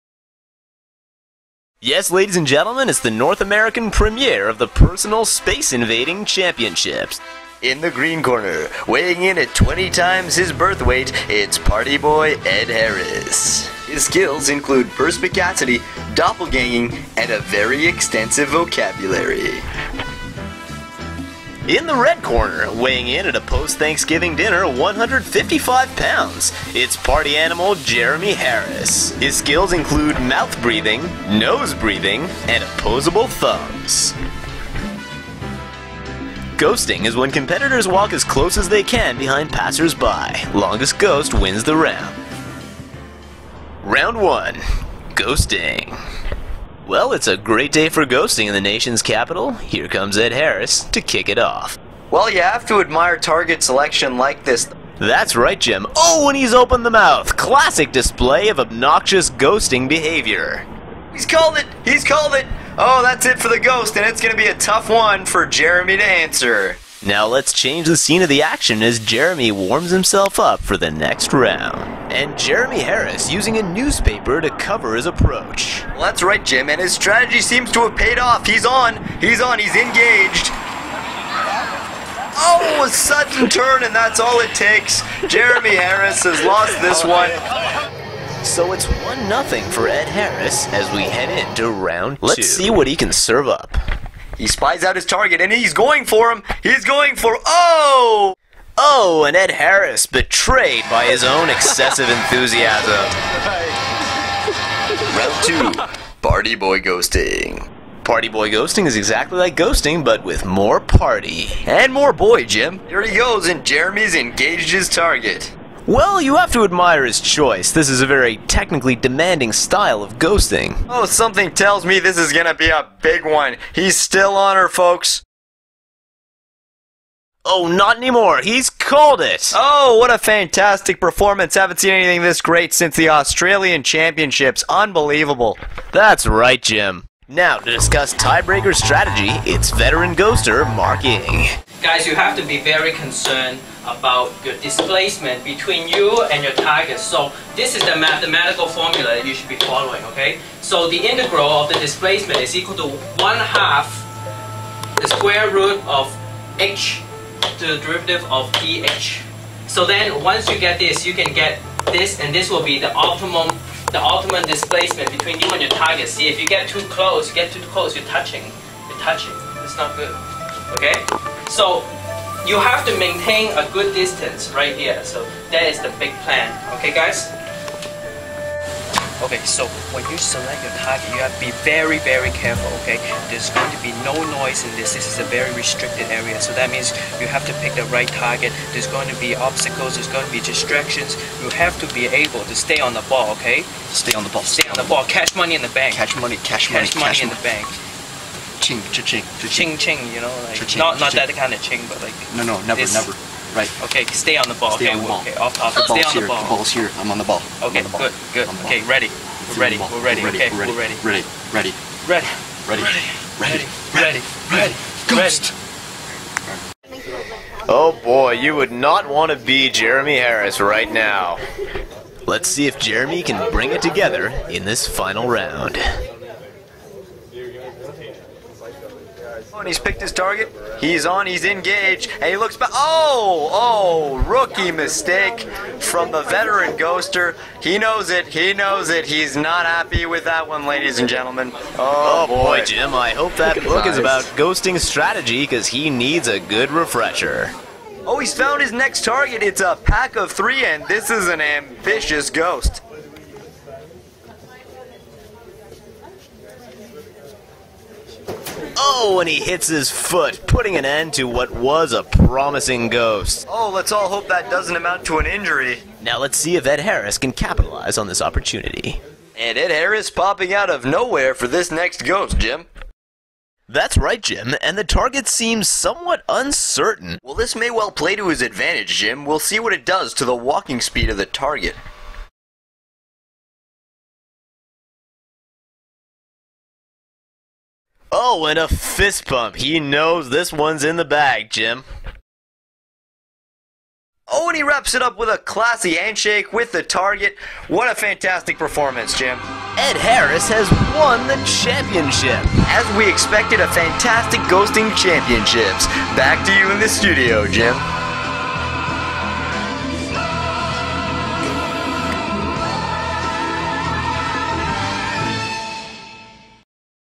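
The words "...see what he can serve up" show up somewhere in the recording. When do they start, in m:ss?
1:32.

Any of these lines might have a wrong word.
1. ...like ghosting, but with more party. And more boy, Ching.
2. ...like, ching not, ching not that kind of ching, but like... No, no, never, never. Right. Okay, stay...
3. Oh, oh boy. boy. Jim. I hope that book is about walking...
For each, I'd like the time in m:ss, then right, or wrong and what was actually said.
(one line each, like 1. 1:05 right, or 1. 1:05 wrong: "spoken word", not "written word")
1. 1:49 wrong: "Jim", not "Ching"
2. 3:20 right
3. 4:01 wrong: "ghosting", not "walking".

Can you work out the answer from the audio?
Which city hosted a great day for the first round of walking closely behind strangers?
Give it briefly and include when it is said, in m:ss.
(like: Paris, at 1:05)
the nation's capital, at 0:48.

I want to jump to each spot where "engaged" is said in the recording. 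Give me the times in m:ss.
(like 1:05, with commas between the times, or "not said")
1:19, 1:54, 3:51.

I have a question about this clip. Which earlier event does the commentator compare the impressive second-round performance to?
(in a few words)
Australian Championships.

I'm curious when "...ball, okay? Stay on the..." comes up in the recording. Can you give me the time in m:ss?
3:13.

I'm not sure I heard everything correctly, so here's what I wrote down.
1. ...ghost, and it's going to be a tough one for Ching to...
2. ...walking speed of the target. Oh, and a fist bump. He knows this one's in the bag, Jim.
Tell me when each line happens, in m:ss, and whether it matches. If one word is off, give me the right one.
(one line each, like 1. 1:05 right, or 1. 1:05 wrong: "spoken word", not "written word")
1. 1:03 wrong: "Jeremie", not "Ching"
2. 4:40 right.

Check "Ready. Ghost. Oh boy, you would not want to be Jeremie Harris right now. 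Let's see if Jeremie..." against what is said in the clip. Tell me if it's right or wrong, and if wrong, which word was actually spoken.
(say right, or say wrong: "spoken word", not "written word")
right.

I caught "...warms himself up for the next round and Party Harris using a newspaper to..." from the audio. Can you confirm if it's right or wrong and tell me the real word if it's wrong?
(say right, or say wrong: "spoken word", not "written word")
wrong: "Jeremie", not "Party".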